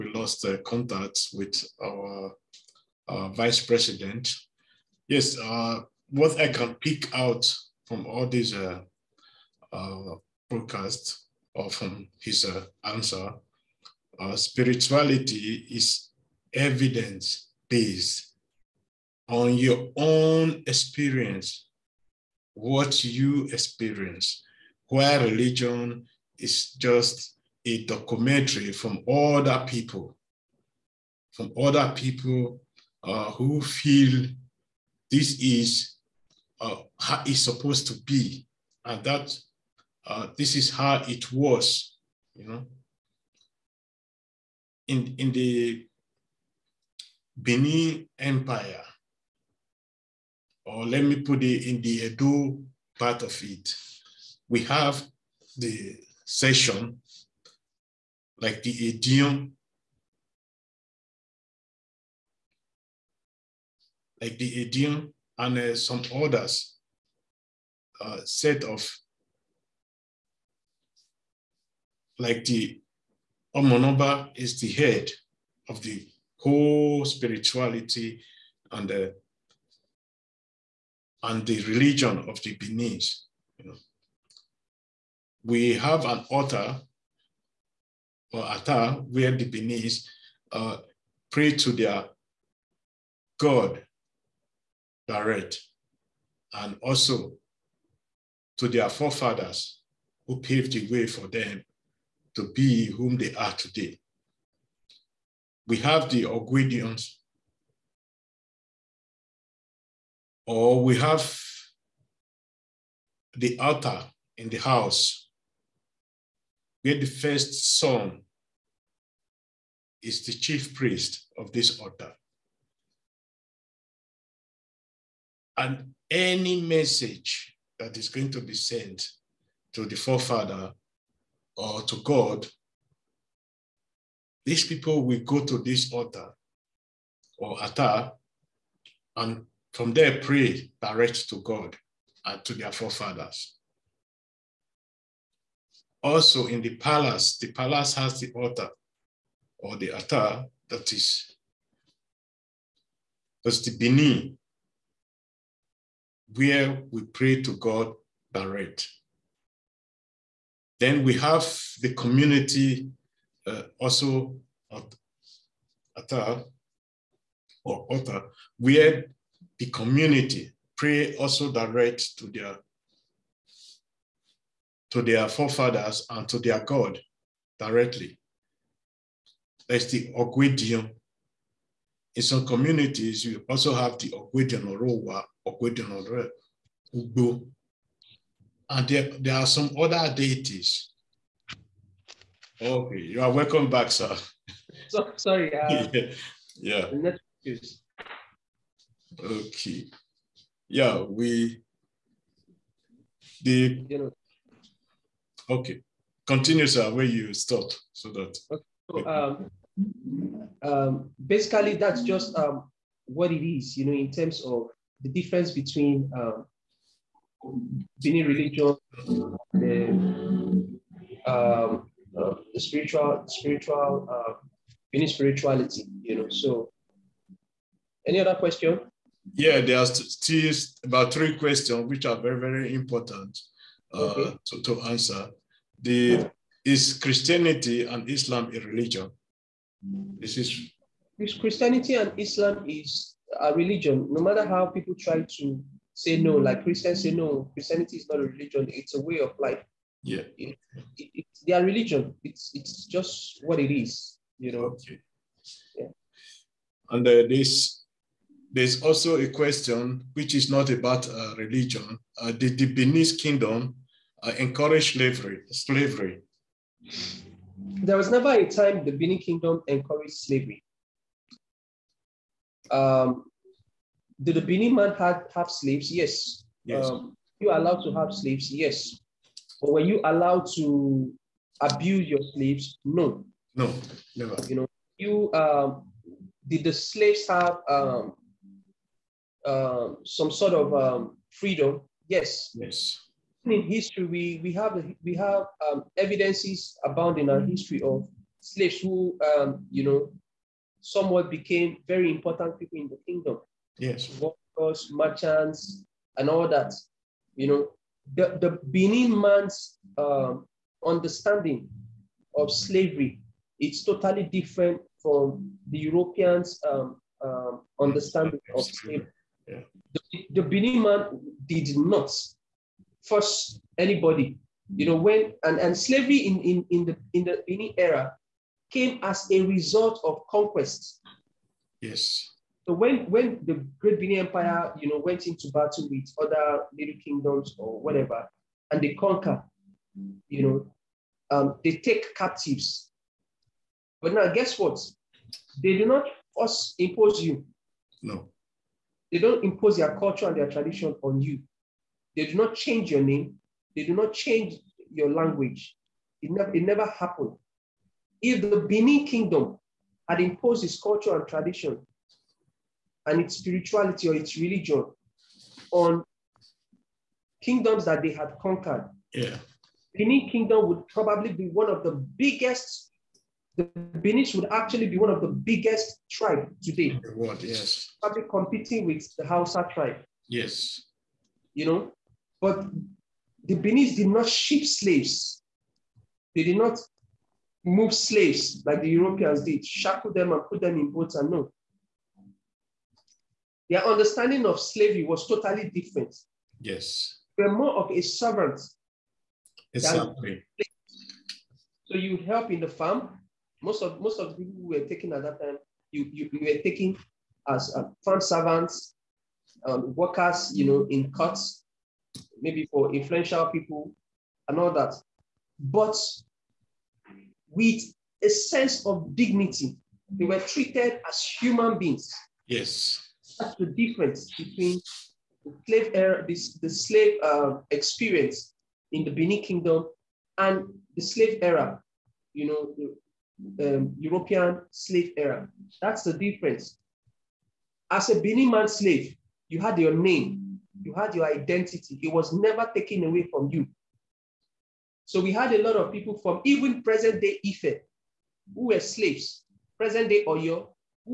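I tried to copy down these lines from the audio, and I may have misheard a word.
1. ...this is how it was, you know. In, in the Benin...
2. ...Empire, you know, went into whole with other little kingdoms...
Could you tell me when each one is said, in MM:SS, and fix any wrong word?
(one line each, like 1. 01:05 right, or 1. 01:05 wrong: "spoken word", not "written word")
1. 00:40 right
2. 05:34 wrong: "battle", not "whole".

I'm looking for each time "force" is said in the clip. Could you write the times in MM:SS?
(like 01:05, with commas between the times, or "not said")
05:23, 05:46.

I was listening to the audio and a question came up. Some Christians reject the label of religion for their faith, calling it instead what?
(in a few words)
A way of life.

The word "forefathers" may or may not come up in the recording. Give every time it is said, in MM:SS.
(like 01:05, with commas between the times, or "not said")
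01:38, 02:09, 02:22, 02:55.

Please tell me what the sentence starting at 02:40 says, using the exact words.
Then we have the community uh, also at, at, or altar, where the community.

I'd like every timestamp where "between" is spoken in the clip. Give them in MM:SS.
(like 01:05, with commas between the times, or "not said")
03:35, 07:04.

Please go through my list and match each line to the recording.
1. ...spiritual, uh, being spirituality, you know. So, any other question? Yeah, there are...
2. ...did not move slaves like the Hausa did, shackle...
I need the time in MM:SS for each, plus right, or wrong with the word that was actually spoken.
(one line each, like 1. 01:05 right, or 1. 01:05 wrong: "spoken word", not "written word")
1. 03:43 right
2. 06:26 wrong: "Europeans", not "Hausa".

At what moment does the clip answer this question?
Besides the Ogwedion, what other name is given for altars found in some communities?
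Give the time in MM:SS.
03:04.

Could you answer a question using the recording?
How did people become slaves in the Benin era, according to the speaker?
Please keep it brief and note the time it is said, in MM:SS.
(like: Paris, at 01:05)
As a result of conquest, at 05:30.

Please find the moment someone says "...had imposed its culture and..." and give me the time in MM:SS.
06:00.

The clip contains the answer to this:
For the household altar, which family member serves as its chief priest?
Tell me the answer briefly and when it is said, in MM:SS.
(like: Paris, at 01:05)
The first son, at 01:57.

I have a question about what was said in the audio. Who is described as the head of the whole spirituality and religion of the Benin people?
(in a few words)
The Omonoba.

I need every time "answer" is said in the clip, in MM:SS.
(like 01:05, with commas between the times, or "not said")
00:12, 03:54.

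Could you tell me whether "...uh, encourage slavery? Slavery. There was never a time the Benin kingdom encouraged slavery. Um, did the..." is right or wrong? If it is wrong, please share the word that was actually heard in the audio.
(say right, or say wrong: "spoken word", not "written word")
right.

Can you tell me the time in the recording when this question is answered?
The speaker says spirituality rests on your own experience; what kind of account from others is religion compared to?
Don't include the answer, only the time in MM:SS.
00:27.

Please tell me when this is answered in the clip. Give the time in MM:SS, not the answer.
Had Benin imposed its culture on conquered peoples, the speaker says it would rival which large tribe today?
06:19.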